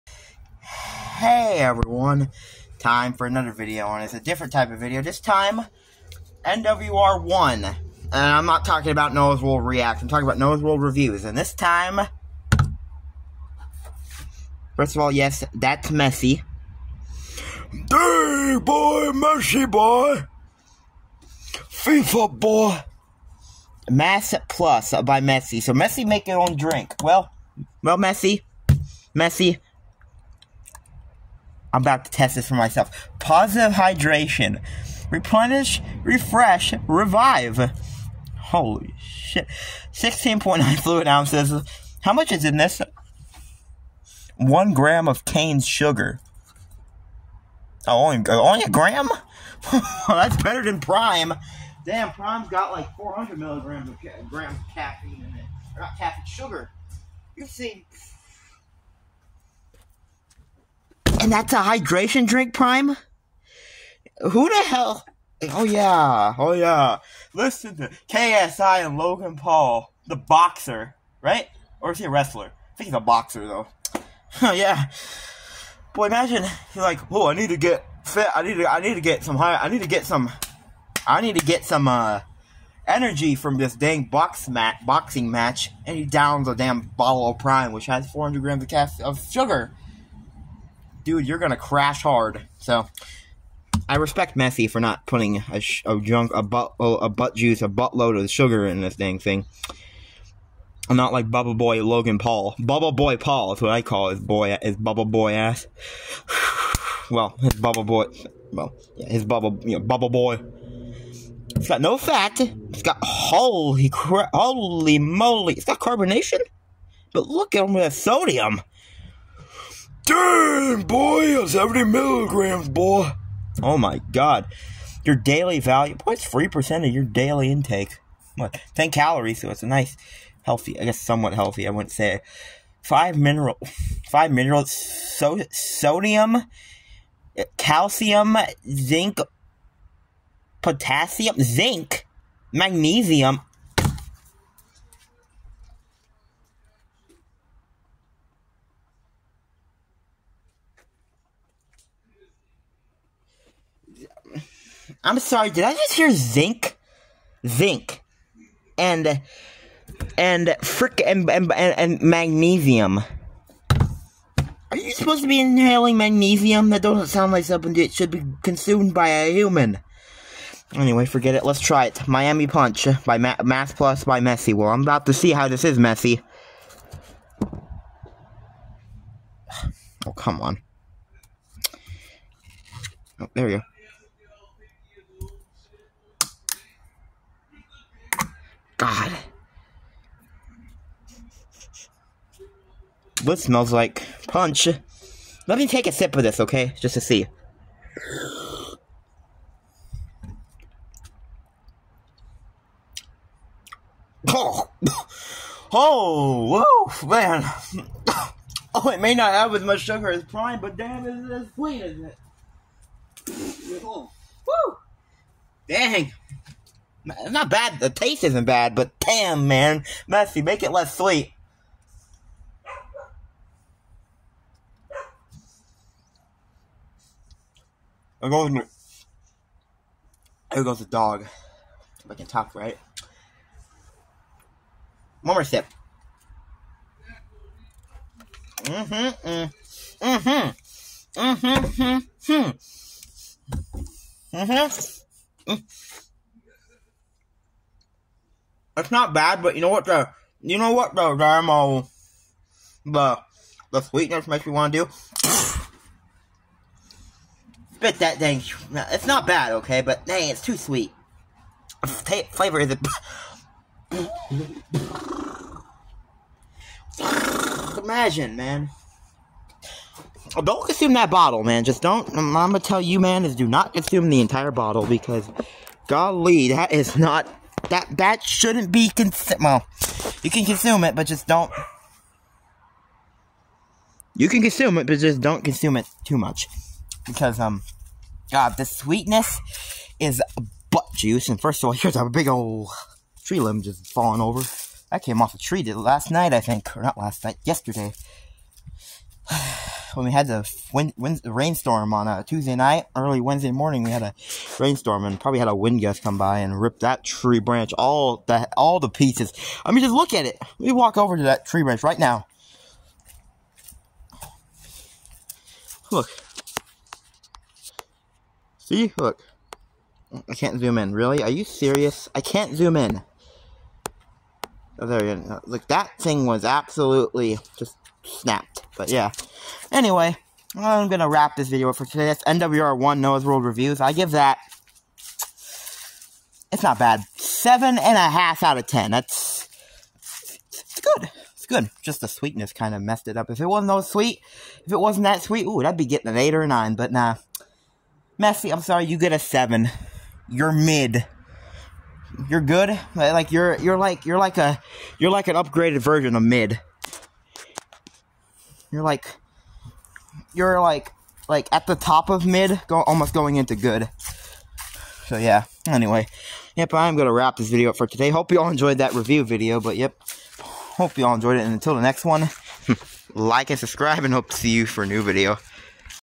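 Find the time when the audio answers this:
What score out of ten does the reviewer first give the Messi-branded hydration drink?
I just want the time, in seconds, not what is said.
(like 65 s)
337 s.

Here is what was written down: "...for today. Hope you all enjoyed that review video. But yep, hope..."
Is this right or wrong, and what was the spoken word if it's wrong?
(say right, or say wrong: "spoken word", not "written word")
right.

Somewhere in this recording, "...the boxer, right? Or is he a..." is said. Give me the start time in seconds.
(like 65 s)
70 s.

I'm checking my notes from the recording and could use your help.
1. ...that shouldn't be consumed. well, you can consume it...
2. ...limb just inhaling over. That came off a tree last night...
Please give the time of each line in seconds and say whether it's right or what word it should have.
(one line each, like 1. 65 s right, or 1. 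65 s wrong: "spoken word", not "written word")
1. 277 s right
2. 293 s wrong: "falling", not "inhaling".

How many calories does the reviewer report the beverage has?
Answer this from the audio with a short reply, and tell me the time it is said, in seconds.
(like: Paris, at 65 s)
10, at 128 s.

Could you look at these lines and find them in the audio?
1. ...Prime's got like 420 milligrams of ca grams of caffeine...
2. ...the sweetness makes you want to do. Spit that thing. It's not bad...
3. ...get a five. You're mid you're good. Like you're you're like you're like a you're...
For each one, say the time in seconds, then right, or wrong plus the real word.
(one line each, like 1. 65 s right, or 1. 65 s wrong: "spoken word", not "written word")
1. 52 s wrong: "400", not "420"
2. 253 s right
3. 348 s wrong: "seven", not "five".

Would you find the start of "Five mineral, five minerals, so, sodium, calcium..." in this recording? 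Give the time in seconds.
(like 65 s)
132 s.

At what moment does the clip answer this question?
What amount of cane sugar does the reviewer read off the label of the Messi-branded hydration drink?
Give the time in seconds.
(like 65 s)
44 s.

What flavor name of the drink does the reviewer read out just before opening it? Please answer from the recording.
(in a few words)
Miami Punch.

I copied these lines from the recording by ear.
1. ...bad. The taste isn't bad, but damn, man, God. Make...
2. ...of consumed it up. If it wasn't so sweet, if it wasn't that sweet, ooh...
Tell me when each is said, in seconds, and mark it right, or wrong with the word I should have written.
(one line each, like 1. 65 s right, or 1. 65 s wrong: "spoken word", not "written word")
1. 217 s wrong: "Messi", not "God"
2. 342 s wrong: "messed", not "consumed".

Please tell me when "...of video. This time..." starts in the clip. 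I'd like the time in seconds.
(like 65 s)
4 s.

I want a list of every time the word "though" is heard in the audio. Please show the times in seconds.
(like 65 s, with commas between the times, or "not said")
73 s.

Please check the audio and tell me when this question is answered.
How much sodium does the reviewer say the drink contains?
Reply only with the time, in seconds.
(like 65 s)
121 s.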